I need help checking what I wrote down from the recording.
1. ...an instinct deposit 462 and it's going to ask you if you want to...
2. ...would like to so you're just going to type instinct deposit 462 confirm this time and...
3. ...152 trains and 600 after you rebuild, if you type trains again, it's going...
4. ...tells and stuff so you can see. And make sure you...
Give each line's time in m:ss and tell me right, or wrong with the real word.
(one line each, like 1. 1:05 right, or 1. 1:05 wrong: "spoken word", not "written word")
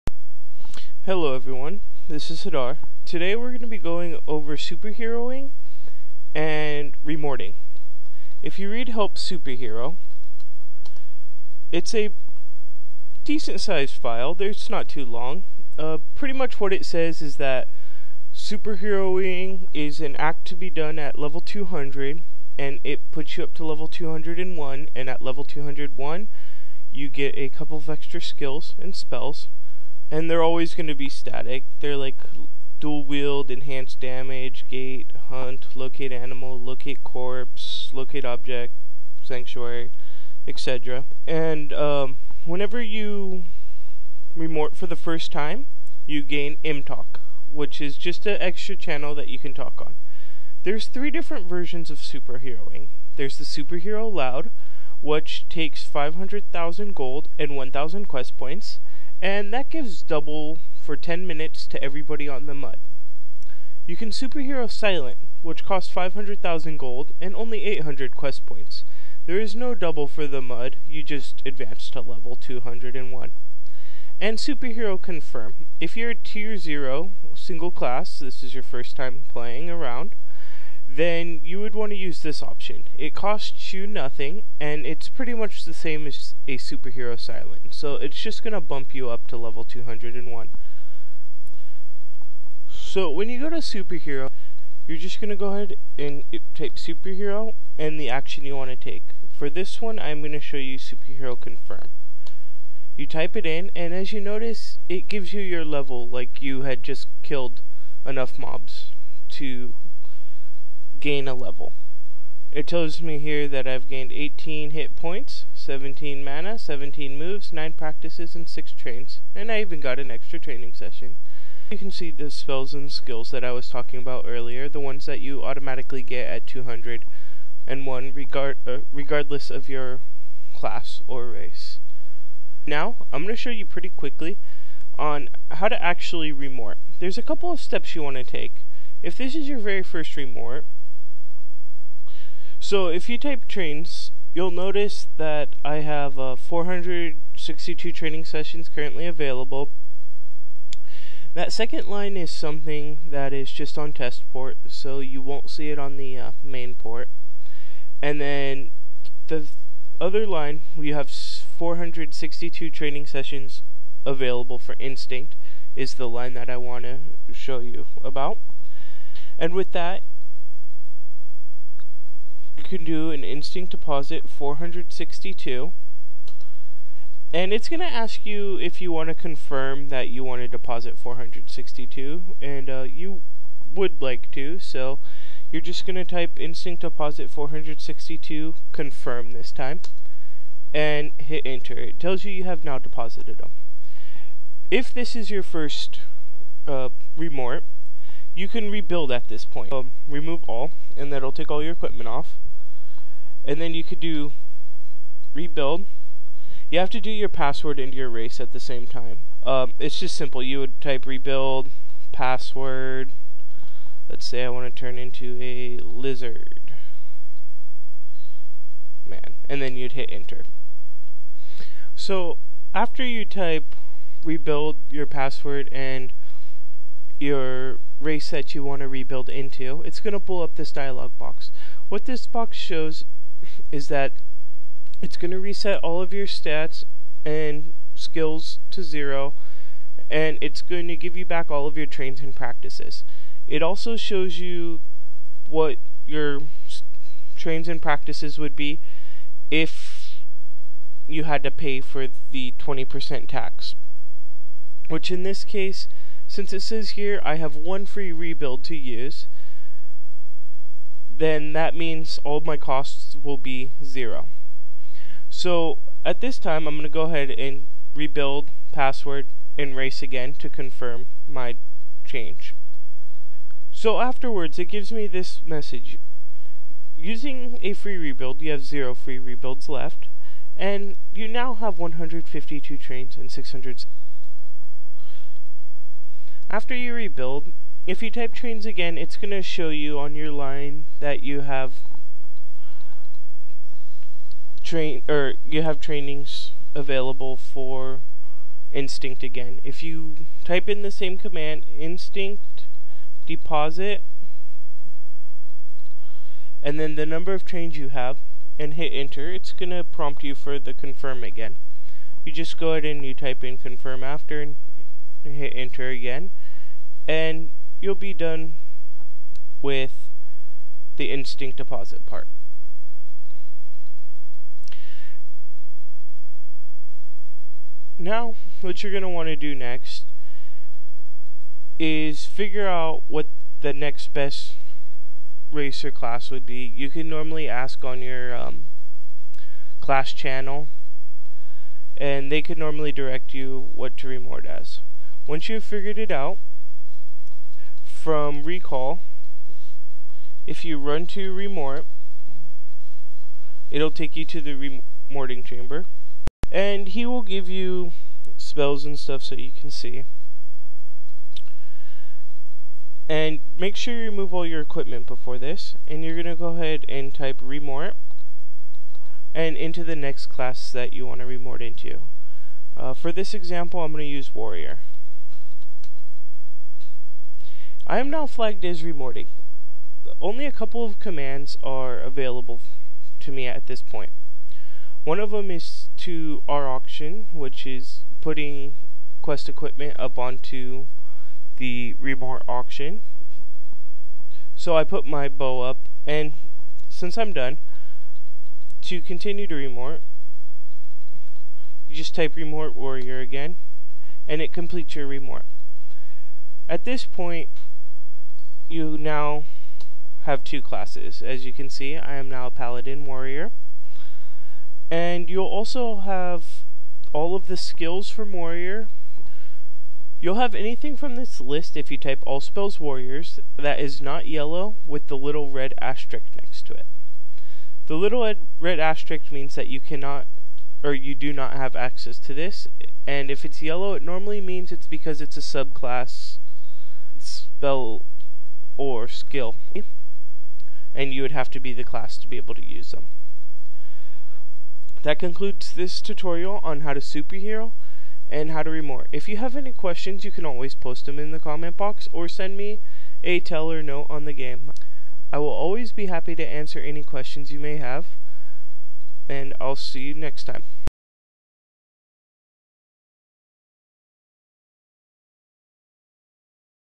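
1. 2:53 right
2. 3:03 right
3. 4:41 right
4. 5:58 wrong: "spells", not "tells".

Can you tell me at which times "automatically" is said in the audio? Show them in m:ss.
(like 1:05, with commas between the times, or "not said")
2:05.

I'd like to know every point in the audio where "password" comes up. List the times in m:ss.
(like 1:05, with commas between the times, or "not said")
3:27, 3:32, 3:45, 4:28.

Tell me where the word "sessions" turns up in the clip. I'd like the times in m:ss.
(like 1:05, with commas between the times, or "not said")
2:00, 2:28, 2:43.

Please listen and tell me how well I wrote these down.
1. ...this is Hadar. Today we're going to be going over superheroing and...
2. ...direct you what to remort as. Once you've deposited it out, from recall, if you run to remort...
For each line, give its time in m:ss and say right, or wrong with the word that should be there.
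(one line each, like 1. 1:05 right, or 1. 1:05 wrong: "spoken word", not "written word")
1. 0:02 right
2. 5:42 wrong: "figured", not "deposited".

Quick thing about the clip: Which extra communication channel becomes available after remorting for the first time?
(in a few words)
M-talk.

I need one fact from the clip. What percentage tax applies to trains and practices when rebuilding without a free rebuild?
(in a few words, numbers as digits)
20%.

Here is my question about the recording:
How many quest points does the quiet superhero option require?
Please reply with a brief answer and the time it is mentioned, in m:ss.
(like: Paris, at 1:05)
800, at 1:07.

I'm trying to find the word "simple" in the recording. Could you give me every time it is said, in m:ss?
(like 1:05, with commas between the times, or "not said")
3:30.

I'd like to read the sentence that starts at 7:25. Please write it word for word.
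That concludes this tutorial on how to superhero and how to remort.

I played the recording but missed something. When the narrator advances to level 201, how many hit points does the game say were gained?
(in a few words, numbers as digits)
18.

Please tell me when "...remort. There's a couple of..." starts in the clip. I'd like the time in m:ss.
2:16.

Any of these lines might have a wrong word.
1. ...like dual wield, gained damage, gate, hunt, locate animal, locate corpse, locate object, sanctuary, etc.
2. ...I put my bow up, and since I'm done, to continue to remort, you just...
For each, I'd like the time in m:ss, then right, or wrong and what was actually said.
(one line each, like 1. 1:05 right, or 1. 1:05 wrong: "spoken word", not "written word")
1. 0:31 wrong: "enhanced", not "gained"
2. 6:34 right.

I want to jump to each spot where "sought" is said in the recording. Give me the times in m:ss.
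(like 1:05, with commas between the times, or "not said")
not said.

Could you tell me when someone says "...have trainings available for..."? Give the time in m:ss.
4:55.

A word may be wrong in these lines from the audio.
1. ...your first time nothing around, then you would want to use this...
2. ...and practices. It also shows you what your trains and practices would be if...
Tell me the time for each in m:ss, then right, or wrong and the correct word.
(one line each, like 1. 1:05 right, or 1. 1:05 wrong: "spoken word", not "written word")
1. 1:18 wrong: "playing", not "nothing"
2. 4:02 right.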